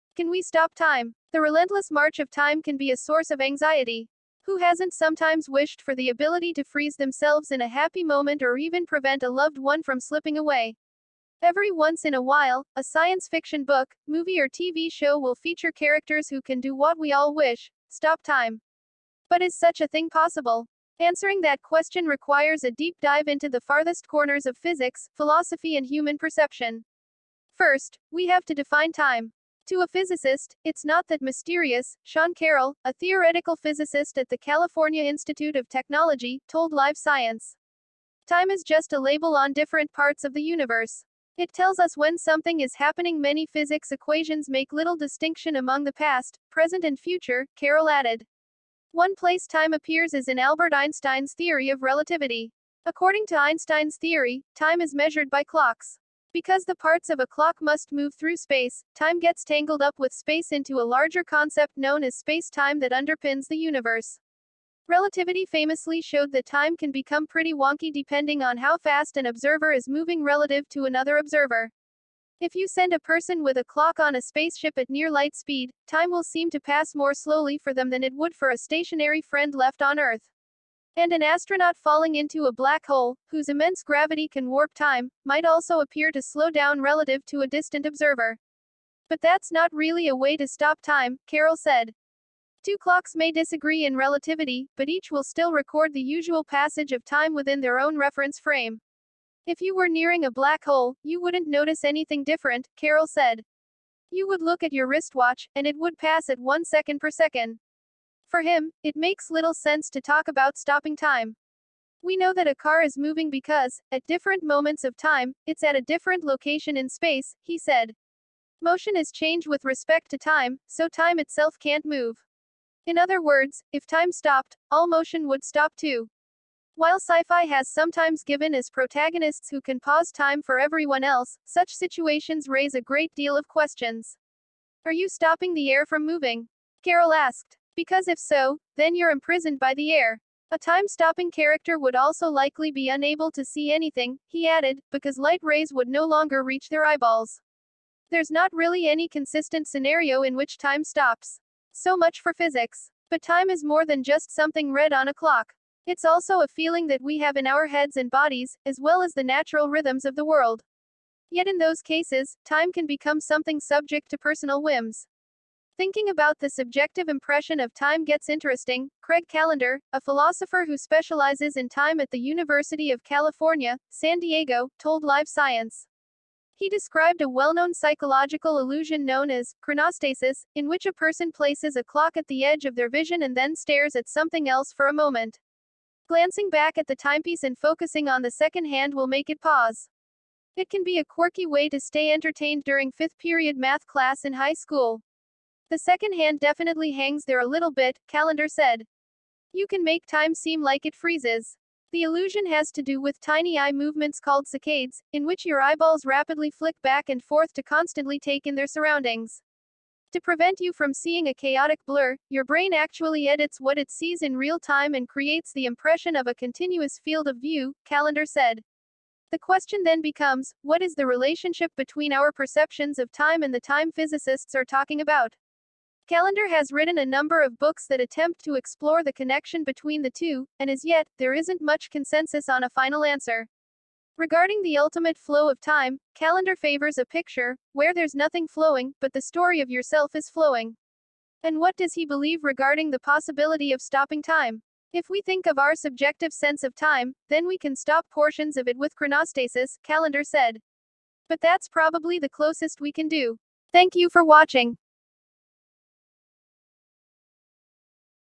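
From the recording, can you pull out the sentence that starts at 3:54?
Regarding the ultimate flow of time, Callender favors a picture, where there's nothing flowing, but the story of yourself is flowing.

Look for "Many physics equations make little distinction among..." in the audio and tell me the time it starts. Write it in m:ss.
0:43.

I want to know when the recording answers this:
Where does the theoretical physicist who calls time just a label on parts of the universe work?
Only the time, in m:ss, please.
0:34.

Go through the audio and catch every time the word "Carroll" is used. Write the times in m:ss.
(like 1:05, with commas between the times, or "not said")
0:32, 0:47, 1:31, 1:42, 2:16.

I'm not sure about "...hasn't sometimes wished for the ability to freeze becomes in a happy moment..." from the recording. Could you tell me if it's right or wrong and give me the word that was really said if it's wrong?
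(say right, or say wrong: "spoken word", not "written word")
wrong: "themselves", not "becomes".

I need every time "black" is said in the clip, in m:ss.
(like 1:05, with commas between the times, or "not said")
1:22, 1:40.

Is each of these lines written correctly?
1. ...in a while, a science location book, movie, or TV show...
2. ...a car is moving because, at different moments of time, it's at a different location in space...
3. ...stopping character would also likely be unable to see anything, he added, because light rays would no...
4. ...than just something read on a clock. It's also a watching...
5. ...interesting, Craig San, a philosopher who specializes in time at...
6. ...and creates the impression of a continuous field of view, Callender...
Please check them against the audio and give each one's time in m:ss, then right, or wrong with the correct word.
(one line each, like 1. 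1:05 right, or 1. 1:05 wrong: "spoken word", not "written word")
1. 0:12 wrong: "fiction", not "location"
2. 1:52 right
3. 2:20 right
4. 2:33 wrong: "feeling", not "watching"
5. 2:48 wrong: "Callender", not "San"
6. 3:34 right.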